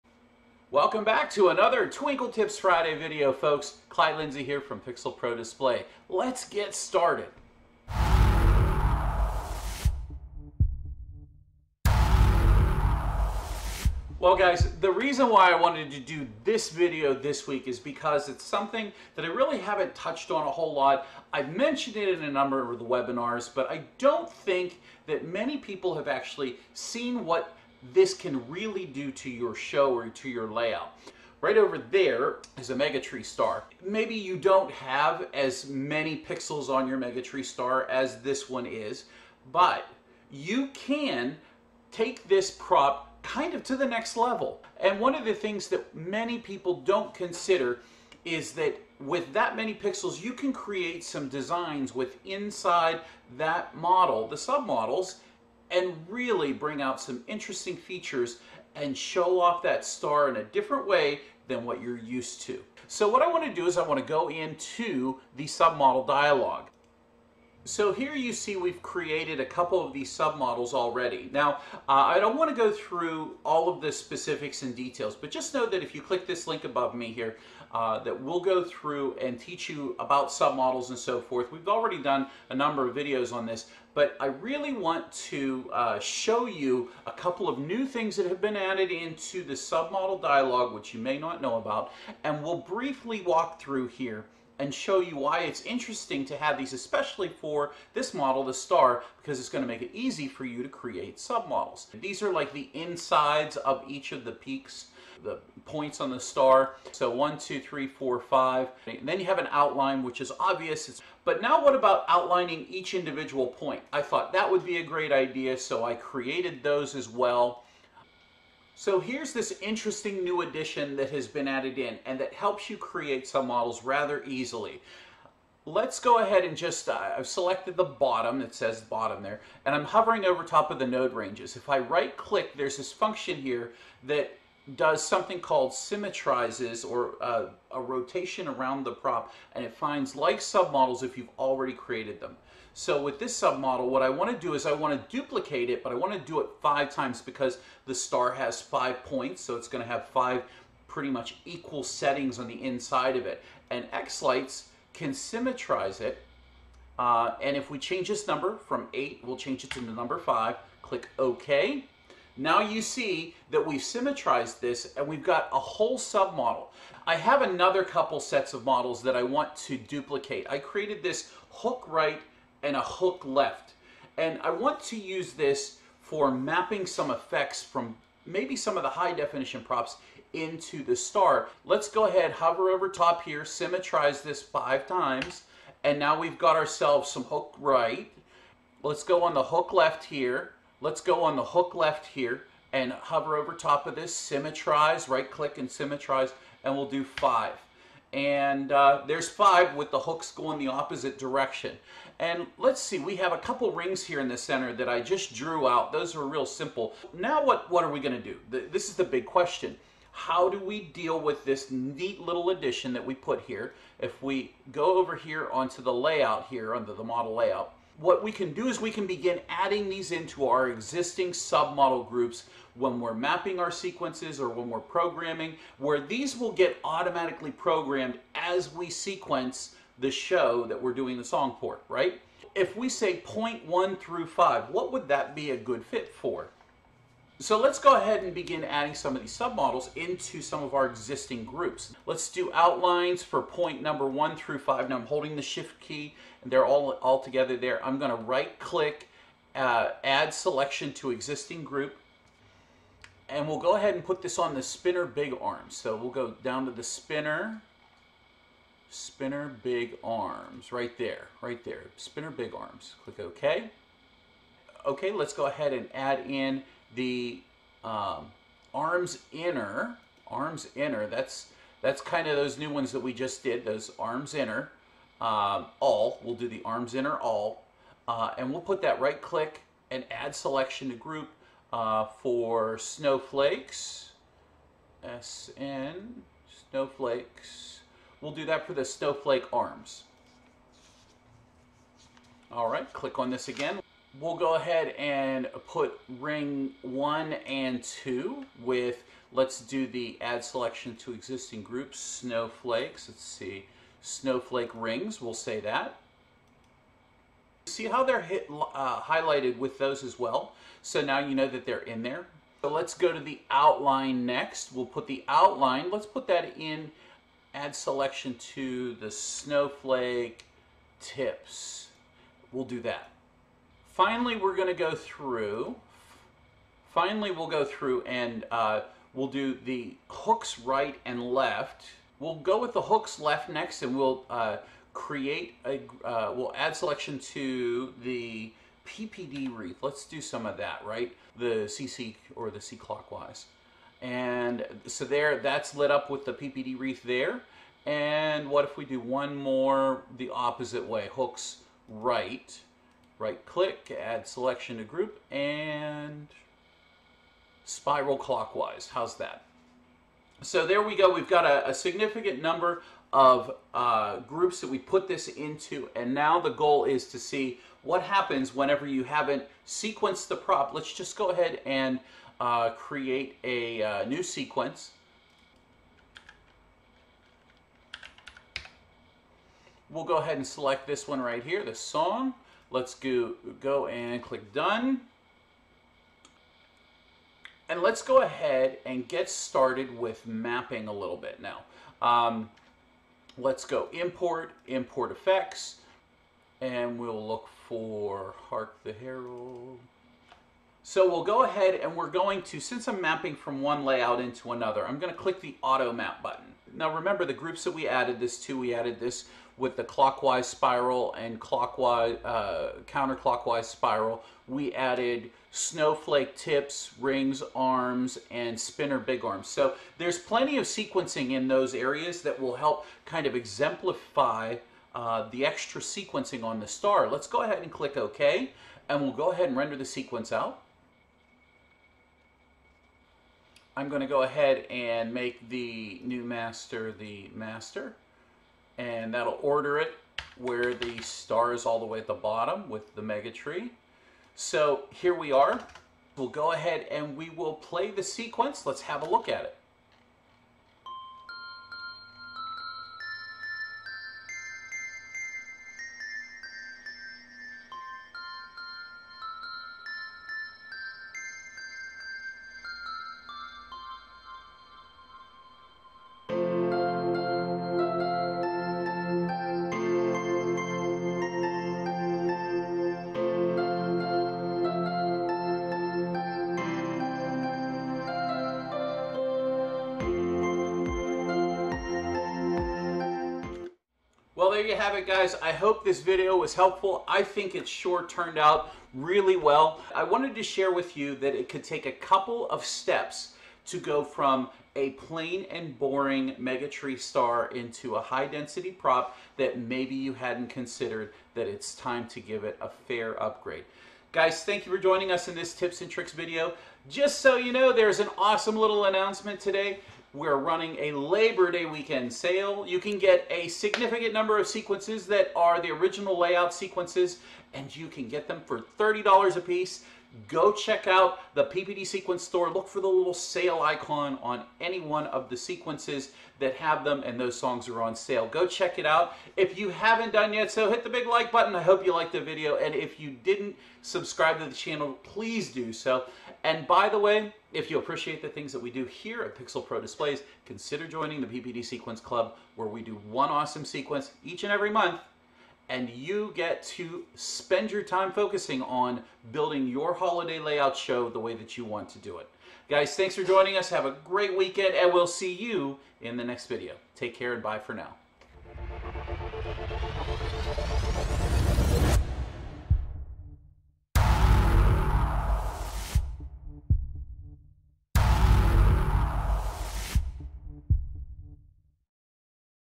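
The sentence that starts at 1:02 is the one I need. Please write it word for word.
So what I want to do is I want to go into the submodel dialog.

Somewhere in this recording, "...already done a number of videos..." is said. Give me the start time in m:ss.
1:21.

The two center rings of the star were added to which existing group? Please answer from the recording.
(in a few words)
snowflake rings.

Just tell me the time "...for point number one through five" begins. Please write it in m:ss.
4:03.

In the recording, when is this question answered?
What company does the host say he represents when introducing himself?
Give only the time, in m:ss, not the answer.
0:04.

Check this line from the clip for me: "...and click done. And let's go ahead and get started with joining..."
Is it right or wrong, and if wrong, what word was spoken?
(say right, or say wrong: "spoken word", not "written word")
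wrong: "mapping", not "joining".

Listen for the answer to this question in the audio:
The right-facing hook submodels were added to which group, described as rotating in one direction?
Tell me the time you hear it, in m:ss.
5:57.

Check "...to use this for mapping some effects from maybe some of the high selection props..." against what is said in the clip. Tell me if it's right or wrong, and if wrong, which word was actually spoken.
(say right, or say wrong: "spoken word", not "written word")
wrong: "definition", not "selection".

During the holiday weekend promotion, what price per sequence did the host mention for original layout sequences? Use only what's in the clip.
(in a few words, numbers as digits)
$30.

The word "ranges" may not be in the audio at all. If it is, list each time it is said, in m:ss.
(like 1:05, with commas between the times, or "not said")
2:11.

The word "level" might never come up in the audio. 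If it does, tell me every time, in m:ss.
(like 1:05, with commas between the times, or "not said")
0:44.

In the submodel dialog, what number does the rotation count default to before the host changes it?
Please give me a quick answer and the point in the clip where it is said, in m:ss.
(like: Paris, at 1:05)
8, at 2:38.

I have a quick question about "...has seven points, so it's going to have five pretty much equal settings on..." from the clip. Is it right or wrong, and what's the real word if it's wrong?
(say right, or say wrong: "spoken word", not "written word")
wrong: "five", not "seven".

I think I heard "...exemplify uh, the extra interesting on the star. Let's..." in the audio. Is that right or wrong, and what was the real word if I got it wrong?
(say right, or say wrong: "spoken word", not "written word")
wrong: "sequencing", not "interesting".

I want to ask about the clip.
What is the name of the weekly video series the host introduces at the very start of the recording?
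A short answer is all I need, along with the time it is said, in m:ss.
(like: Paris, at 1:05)
Twinkle Tips Friday, at 0:01.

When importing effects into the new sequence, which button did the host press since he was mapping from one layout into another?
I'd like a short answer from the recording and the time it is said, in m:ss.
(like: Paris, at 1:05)
auto map, at 6:45.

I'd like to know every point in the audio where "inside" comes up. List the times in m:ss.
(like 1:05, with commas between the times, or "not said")
0:52, 1:42, 2:32.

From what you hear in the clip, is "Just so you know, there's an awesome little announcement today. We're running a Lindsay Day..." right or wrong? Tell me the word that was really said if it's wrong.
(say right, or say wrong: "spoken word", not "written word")
wrong: "Labor", not "Lindsay".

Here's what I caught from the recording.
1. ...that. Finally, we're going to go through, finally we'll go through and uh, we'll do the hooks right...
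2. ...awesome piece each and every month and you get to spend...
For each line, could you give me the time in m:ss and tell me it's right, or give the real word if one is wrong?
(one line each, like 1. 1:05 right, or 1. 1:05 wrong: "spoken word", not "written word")
1. 5:22 right
2. 9:03 wrong: "sequence", not "piece".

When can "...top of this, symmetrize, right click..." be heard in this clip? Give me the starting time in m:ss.
3:13.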